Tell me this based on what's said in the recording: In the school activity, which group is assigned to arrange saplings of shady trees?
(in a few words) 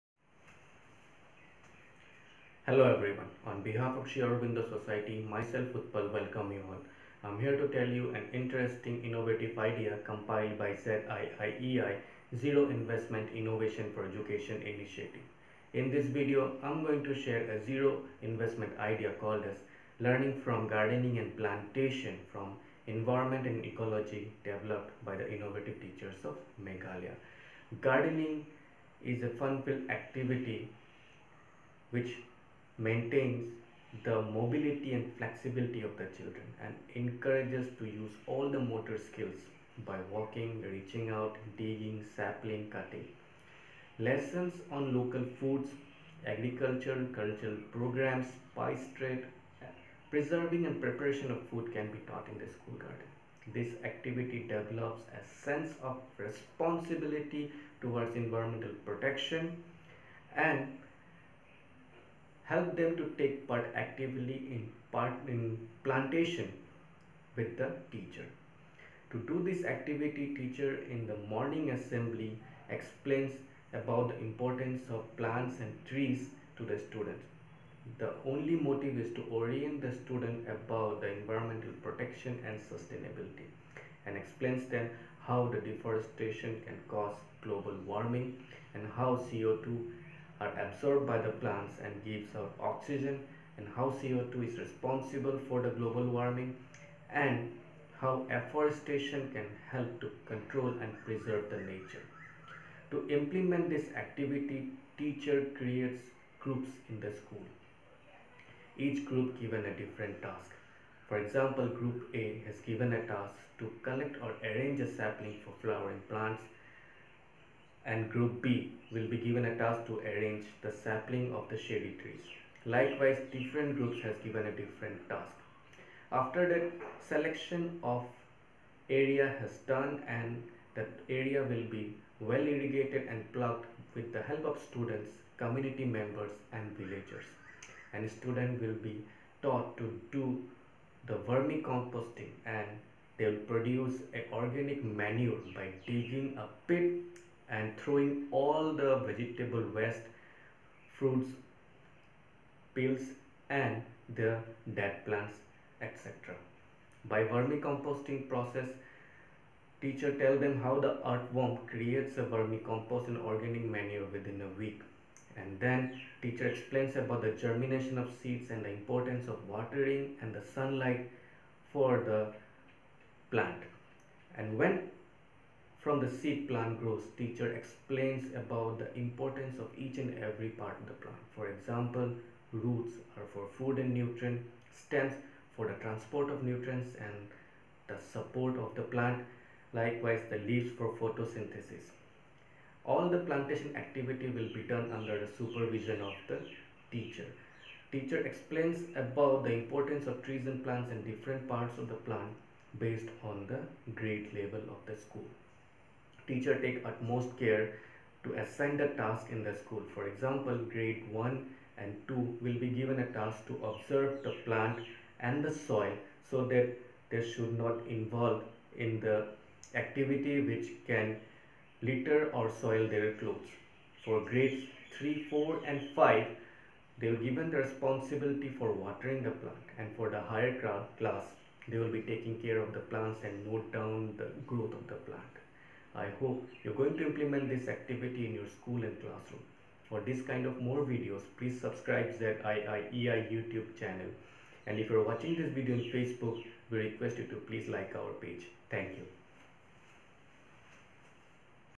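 Group B.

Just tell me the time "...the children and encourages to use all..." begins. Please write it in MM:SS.
00:35.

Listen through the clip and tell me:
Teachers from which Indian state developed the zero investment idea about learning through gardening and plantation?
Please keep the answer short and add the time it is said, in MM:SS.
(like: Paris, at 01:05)
Meghalaya, at 00:26.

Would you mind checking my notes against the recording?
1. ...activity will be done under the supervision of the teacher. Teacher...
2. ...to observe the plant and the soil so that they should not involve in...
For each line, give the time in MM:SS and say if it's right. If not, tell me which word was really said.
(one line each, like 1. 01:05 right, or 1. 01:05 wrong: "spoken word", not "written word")
1. 03:13 right
2. 03:33 right.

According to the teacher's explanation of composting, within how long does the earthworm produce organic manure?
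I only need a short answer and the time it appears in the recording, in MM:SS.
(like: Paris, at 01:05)
a week, at 02:44.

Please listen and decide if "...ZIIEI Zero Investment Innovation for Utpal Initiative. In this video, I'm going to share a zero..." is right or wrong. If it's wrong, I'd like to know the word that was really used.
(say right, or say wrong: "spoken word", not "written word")
wrong: "Education", not "Utpal".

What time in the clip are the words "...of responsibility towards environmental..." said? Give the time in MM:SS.
00:55.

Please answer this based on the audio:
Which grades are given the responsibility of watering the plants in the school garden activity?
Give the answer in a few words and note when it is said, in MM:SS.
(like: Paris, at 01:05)
3, 4 and 5, at 03:44.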